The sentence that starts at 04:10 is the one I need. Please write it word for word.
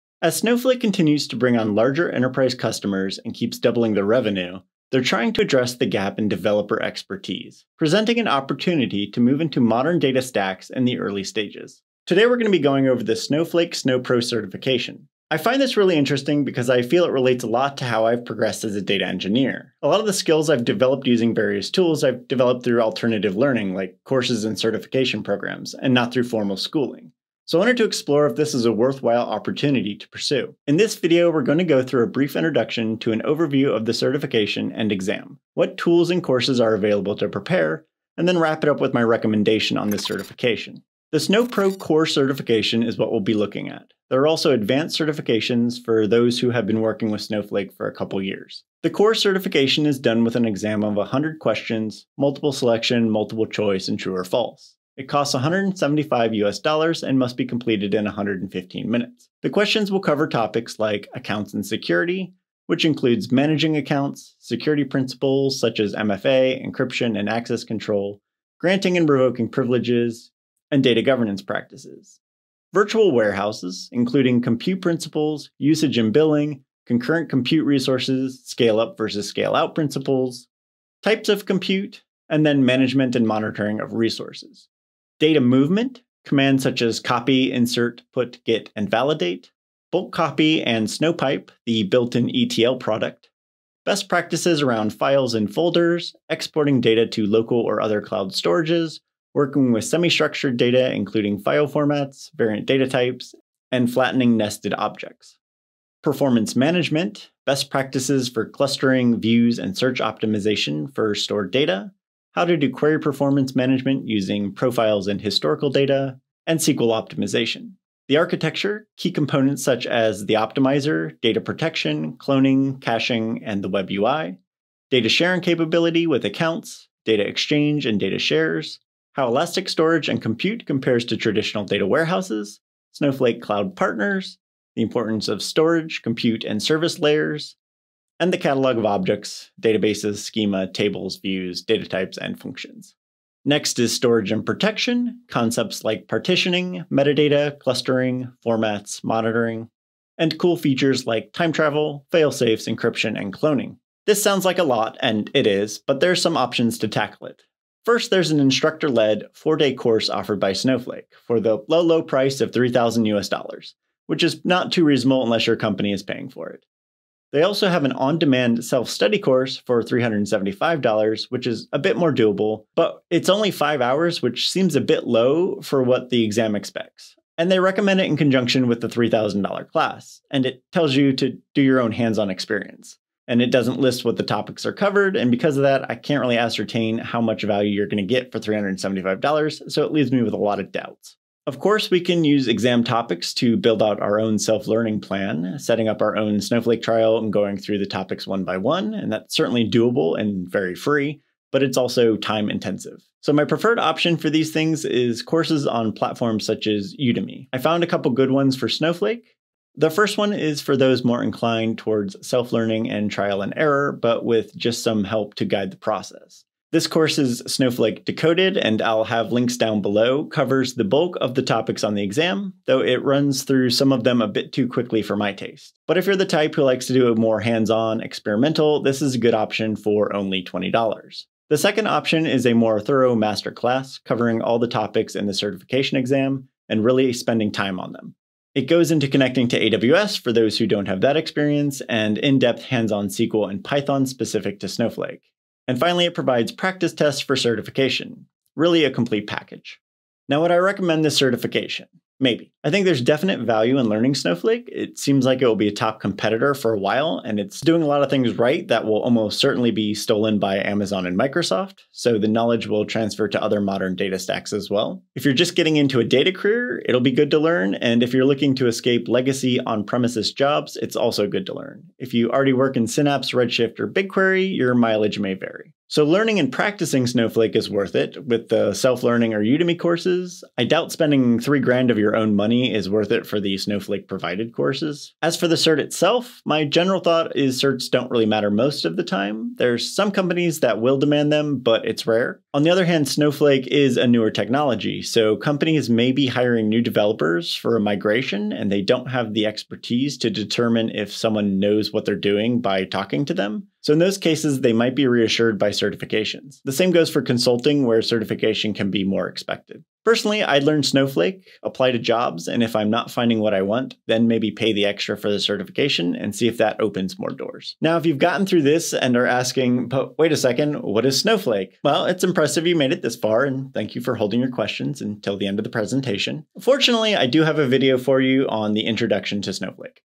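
Now, would I recommend this certification?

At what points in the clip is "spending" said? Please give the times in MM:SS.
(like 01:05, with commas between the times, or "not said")
03:57, 04:40.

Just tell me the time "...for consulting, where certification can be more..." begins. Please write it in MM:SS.
05:07.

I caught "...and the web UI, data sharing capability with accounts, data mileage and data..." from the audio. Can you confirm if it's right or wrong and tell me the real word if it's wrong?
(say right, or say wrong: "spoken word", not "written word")
wrong: "exchange", not "mileage".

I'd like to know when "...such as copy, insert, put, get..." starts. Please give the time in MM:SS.
01:26.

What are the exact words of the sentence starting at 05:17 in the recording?
Now, if you've gotten through this and are asking, but wait a second, what is Snowflake?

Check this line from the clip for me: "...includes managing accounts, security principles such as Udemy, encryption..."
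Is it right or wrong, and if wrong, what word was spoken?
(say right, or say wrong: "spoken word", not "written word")
wrong: "MFA", not "Udemy".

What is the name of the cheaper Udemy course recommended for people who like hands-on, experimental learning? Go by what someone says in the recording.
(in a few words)
Snowflake Decoded.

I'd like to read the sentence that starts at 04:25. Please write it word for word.
If you're just getting into a data career, it'll be good to learn.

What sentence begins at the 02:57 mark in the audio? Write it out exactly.
And they recommend it in conjunction with the $3,000 class, and it tells you to do your own hands on experience.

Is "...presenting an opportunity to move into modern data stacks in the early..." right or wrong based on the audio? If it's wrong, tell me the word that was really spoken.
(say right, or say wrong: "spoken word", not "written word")
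right.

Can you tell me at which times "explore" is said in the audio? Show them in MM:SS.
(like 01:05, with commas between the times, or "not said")
00:27.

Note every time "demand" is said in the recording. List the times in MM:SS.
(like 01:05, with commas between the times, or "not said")
02:48, 04:50.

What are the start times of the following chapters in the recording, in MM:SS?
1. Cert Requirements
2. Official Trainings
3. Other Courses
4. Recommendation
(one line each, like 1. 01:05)
1. 00:49
2. 02:36
3. 03:12
4. 04:11.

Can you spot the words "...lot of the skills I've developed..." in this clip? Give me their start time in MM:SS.
00:19.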